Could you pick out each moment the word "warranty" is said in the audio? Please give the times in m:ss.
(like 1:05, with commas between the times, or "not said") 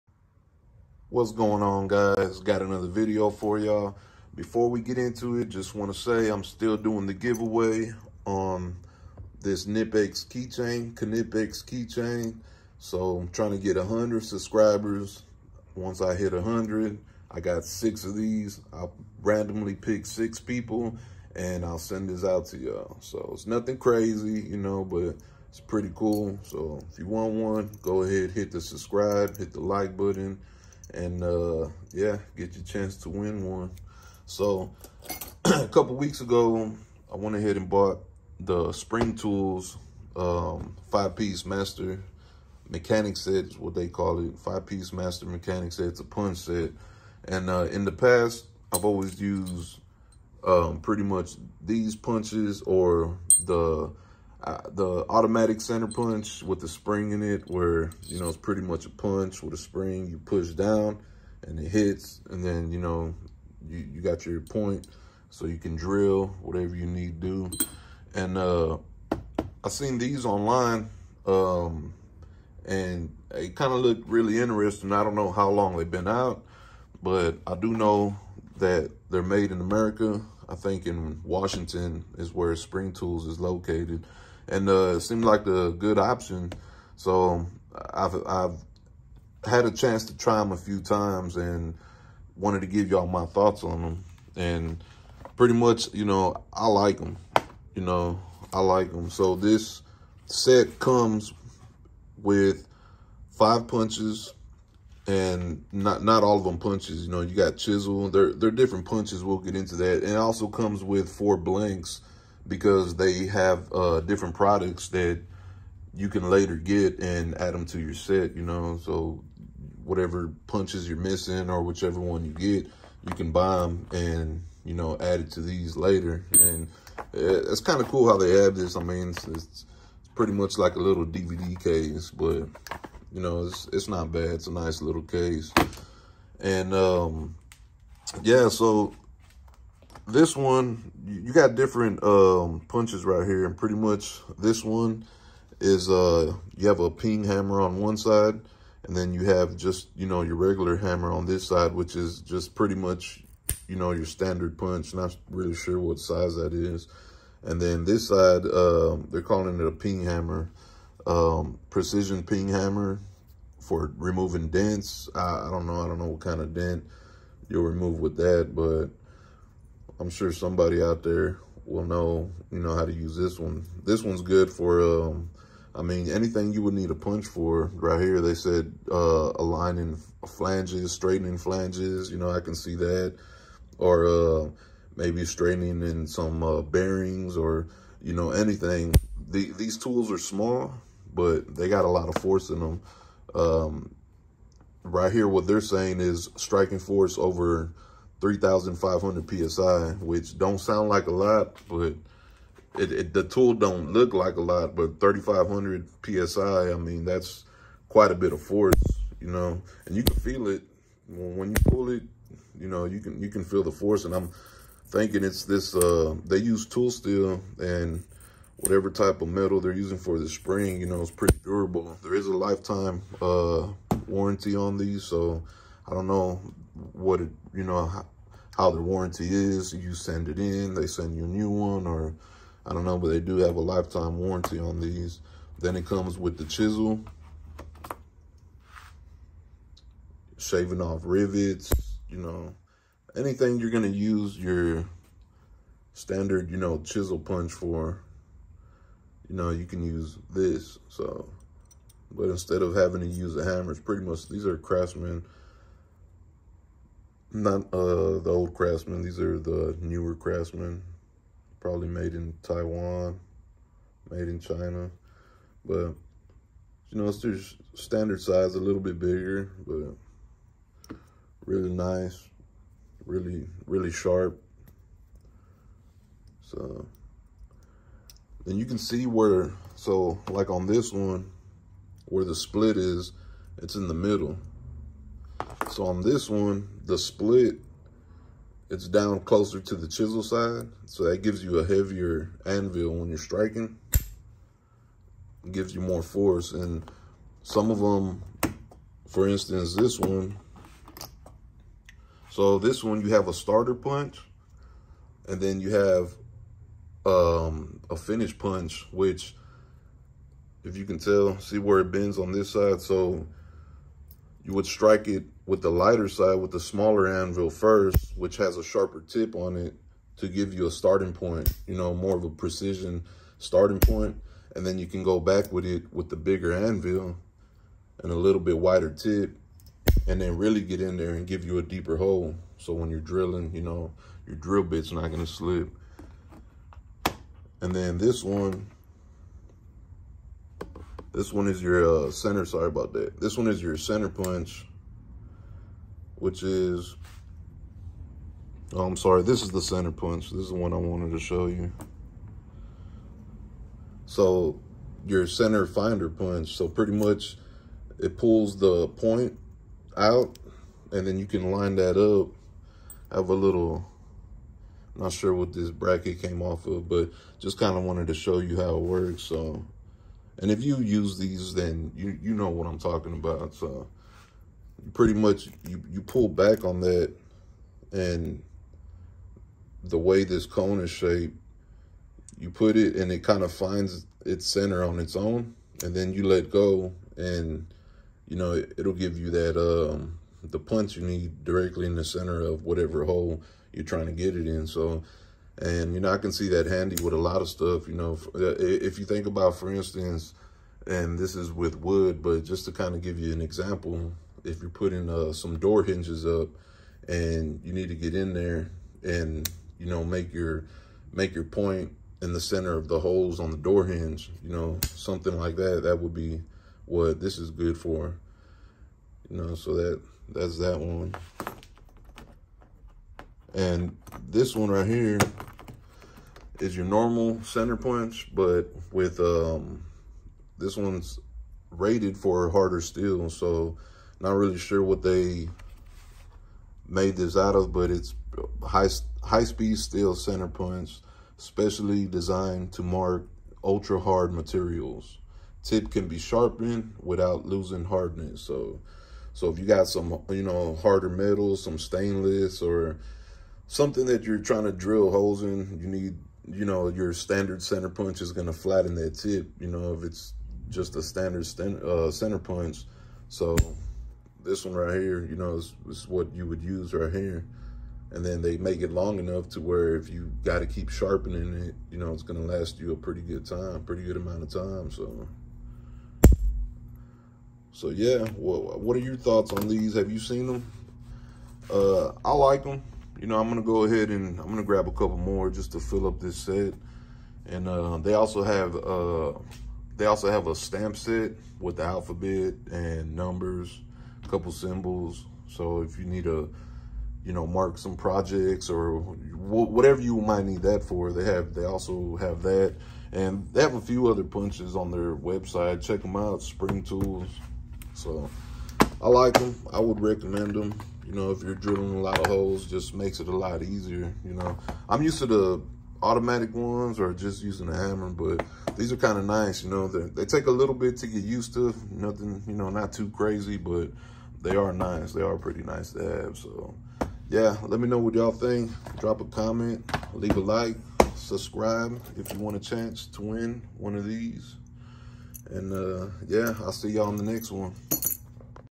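3:44, 3:48, 3:54.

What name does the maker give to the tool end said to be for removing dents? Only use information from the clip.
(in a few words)
Precision ping hammer.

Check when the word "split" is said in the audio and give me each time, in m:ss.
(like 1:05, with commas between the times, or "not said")
4:42, 4:46.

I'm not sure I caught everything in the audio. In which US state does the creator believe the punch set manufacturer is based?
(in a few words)
Washington.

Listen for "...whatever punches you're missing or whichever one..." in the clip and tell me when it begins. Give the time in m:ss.
1:59.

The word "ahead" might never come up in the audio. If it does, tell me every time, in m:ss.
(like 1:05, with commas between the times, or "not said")
0:28, 0:37, 8:03.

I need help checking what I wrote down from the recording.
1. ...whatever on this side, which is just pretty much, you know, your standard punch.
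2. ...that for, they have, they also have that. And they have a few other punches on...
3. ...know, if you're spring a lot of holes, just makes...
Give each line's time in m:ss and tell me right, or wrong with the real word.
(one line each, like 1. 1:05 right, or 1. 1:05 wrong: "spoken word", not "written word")
1. 2:30 wrong: "hammer", not "whatever"
2. 8:20 right
3. 8:31 wrong: "drilling", not "spring".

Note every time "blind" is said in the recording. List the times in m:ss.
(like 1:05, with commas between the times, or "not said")
not said.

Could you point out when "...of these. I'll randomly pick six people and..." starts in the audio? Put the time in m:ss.
0:18.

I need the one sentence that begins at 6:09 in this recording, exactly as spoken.
So, and if you use these, then you, you know what I'm talking about.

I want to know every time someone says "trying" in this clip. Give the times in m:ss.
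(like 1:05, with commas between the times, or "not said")
0:13, 6:33, 7:34.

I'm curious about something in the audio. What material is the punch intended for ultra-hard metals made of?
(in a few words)
High speed steel.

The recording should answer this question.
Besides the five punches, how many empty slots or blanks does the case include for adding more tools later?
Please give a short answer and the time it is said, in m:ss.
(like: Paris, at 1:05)
4, at 1:51.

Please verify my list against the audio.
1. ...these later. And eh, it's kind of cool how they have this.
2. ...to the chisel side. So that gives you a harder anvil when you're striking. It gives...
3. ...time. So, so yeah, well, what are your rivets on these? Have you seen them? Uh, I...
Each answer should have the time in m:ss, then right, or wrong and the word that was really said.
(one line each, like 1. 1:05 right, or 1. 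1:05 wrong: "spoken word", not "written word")
1. 2:05 right
2. 4:49 wrong: "heavier", not "harder"
3. 7:54 wrong: "thoughts", not "rivets".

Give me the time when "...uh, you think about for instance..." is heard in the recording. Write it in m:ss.
6:38.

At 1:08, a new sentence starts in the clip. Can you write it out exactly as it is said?
And uh, I seen these online um, and it kind of looked really interesting.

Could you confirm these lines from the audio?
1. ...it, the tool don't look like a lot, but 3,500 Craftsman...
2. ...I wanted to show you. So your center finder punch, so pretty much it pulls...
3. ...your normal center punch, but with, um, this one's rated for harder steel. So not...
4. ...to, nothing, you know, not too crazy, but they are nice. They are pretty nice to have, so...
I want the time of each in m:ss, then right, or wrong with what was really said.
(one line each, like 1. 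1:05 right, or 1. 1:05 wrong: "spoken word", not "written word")
1. 3:22 wrong: "PSI", not "Craftsman"
2. 5:50 right
3. 7:06 right
4. 8:41 right.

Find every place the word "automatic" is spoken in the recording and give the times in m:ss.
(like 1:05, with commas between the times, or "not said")
0:55, 8:36.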